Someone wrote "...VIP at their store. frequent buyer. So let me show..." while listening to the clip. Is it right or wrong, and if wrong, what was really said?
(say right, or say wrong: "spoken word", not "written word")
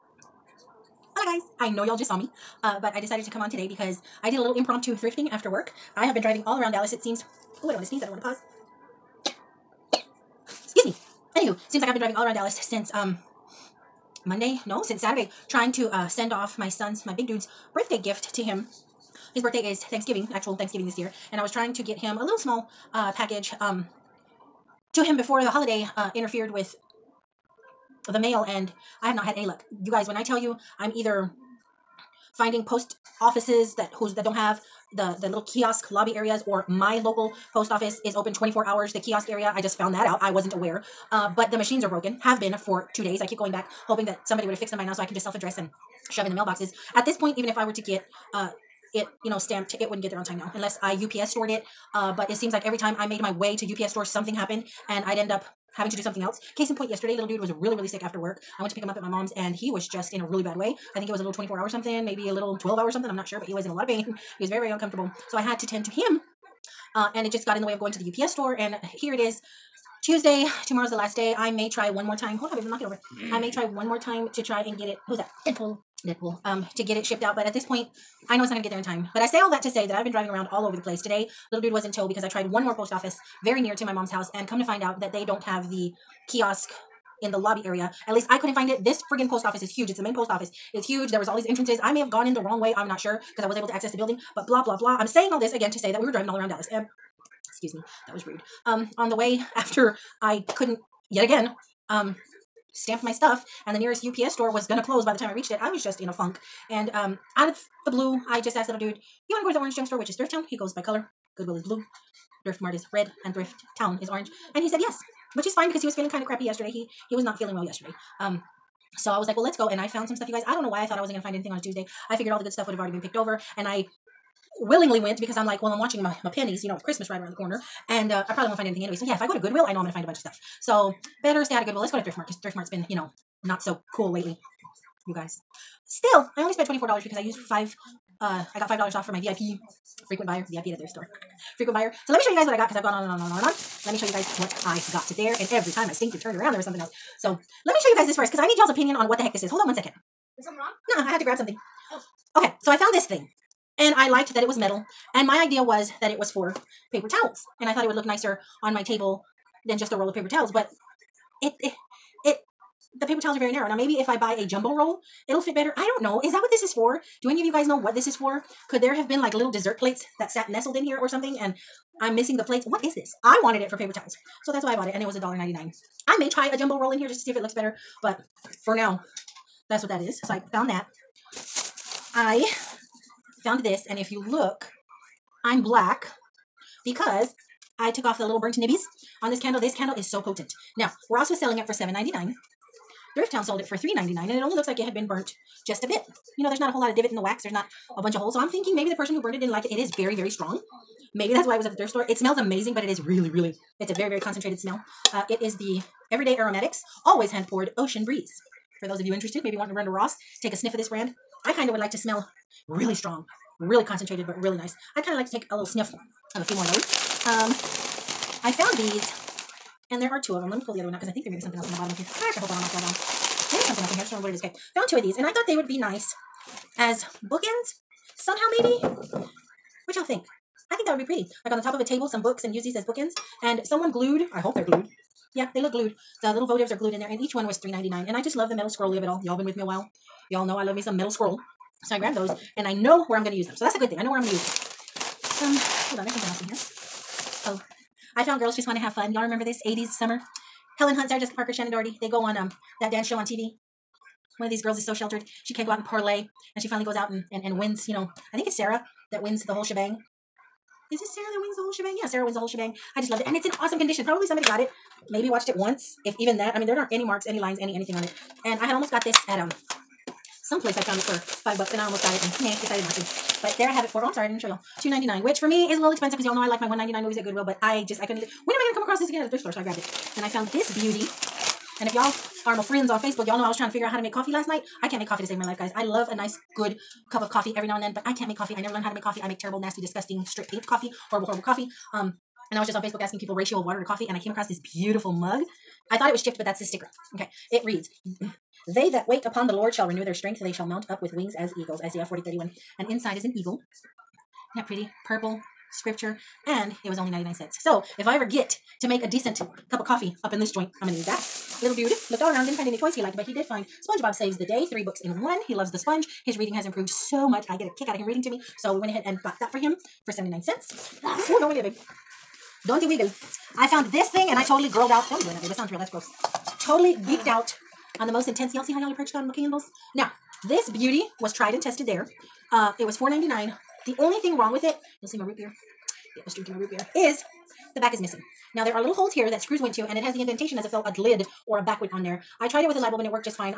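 right.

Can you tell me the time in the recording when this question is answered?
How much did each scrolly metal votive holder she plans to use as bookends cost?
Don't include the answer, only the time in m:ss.
3:57.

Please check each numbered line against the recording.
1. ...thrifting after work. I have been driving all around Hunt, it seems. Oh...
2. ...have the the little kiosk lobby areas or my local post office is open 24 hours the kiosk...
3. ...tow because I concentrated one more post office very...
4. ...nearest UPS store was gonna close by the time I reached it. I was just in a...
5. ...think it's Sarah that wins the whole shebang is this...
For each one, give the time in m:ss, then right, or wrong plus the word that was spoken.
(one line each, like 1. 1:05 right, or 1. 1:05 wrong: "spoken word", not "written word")
1. 0:04 wrong: "Dallas", not "Hunt"
2. 0:34 right
3. 1:21 wrong: "tried", not "concentrated"
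4. 1:43 right
5. 4:18 right.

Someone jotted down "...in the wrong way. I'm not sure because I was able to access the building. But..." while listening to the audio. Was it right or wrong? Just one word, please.
right.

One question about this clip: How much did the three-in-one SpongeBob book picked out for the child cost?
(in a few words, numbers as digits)
79 cents.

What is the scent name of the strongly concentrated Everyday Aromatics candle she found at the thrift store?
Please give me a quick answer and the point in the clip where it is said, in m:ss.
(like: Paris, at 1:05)
Ocean Breeze, at 3:27.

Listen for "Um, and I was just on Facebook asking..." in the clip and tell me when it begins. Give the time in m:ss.
4:51.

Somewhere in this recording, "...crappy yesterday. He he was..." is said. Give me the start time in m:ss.
1:56.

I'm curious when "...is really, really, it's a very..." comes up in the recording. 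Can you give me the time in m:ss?
3:22.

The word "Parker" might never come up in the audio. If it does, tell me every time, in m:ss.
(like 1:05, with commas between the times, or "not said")
4:11.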